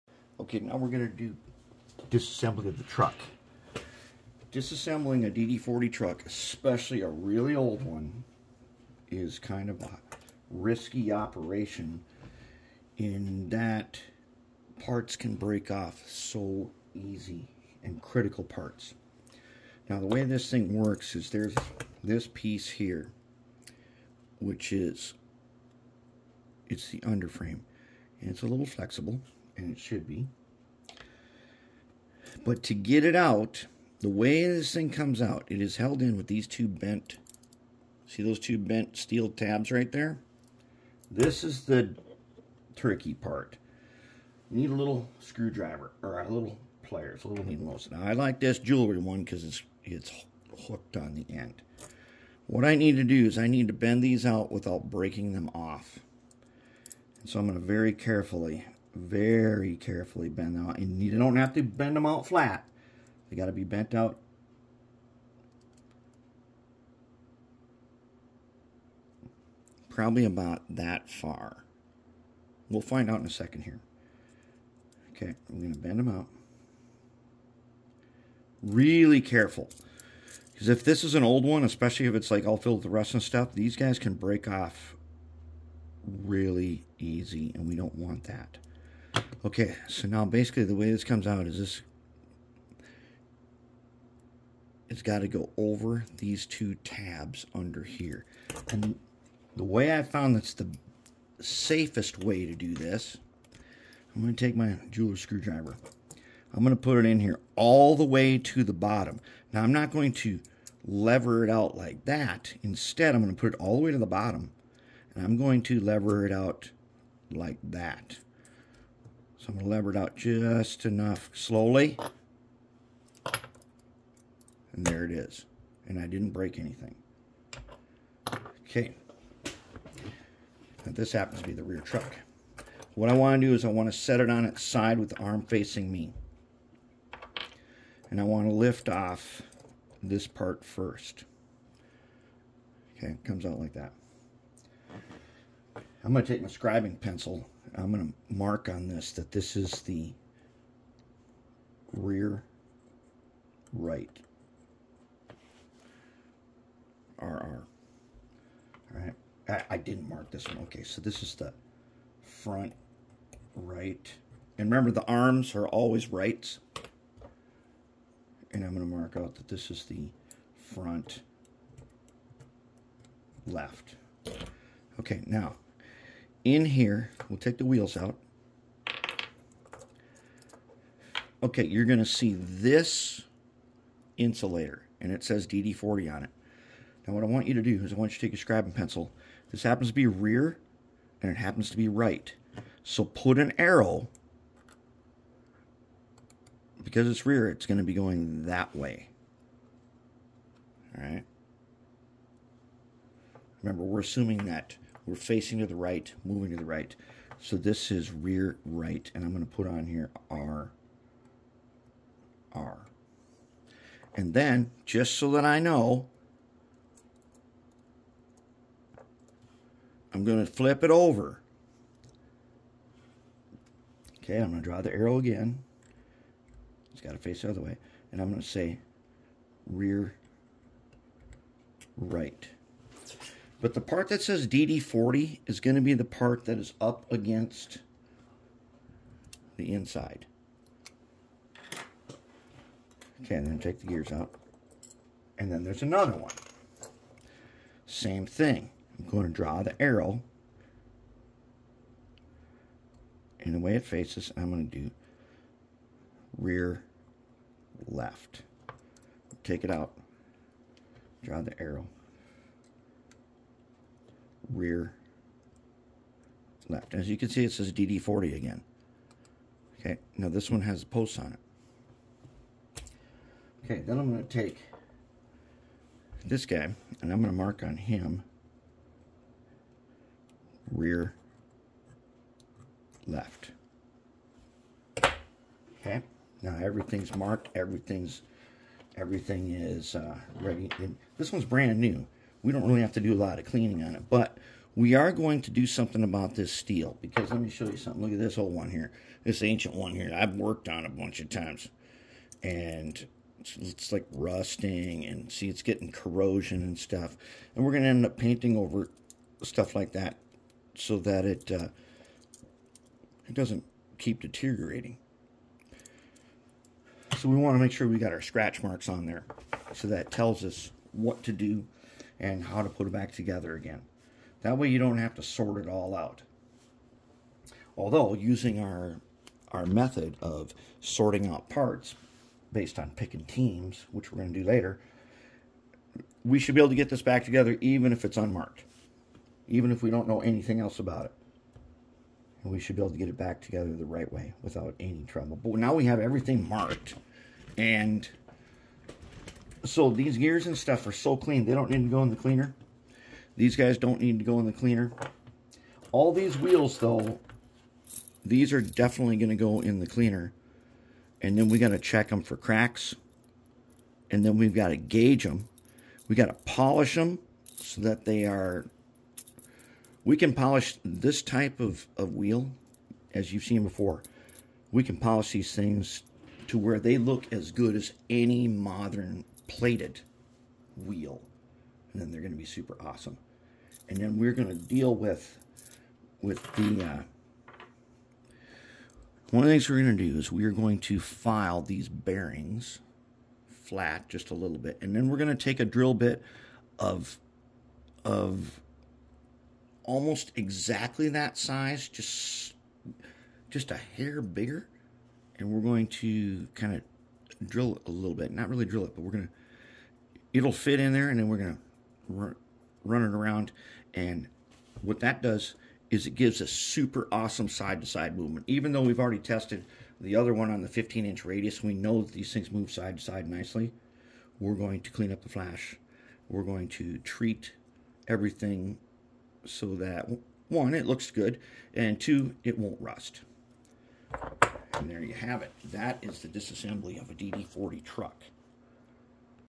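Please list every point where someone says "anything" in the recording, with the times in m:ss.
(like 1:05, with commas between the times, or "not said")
2:06, 5:40.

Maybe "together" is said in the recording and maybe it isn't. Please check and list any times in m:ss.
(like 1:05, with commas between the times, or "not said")
5:23, 5:37, 5:43.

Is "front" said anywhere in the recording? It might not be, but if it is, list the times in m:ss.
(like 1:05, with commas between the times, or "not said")
2:42, 2:50.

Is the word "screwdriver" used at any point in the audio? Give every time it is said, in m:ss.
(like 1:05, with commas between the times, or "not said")
0:45, 1:45.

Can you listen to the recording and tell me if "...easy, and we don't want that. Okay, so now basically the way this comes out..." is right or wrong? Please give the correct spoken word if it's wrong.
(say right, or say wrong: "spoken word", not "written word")
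right.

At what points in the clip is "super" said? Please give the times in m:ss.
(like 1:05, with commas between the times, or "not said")
6:22, 6:56.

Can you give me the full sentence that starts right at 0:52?
What I need to do is I need to bend these out without breaking them off.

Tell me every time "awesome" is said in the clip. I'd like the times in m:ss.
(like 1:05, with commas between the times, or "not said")
6:22, 6:57.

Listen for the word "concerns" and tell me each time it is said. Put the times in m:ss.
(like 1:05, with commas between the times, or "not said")
not said.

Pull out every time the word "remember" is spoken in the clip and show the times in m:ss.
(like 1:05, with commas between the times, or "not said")
2:44, 3:23.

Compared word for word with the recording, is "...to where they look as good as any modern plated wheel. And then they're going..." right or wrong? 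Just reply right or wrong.
right.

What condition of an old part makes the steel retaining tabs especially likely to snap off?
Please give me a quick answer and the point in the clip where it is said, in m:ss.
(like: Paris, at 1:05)
Filled with rust, at 1:22.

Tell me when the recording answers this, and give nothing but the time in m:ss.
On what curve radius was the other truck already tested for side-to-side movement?
7:00.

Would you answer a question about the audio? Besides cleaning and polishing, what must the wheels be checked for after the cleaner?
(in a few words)
Cracks.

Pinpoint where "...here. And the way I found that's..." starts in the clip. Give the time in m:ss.
1:37.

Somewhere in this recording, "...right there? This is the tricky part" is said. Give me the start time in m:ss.
0:39.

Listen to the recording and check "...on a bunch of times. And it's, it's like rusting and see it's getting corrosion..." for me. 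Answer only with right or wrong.
right.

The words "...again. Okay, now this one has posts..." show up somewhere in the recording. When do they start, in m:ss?
4:28.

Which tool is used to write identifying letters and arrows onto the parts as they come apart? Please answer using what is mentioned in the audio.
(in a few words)
Scribing pencil.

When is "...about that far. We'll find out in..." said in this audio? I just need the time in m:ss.
1:10.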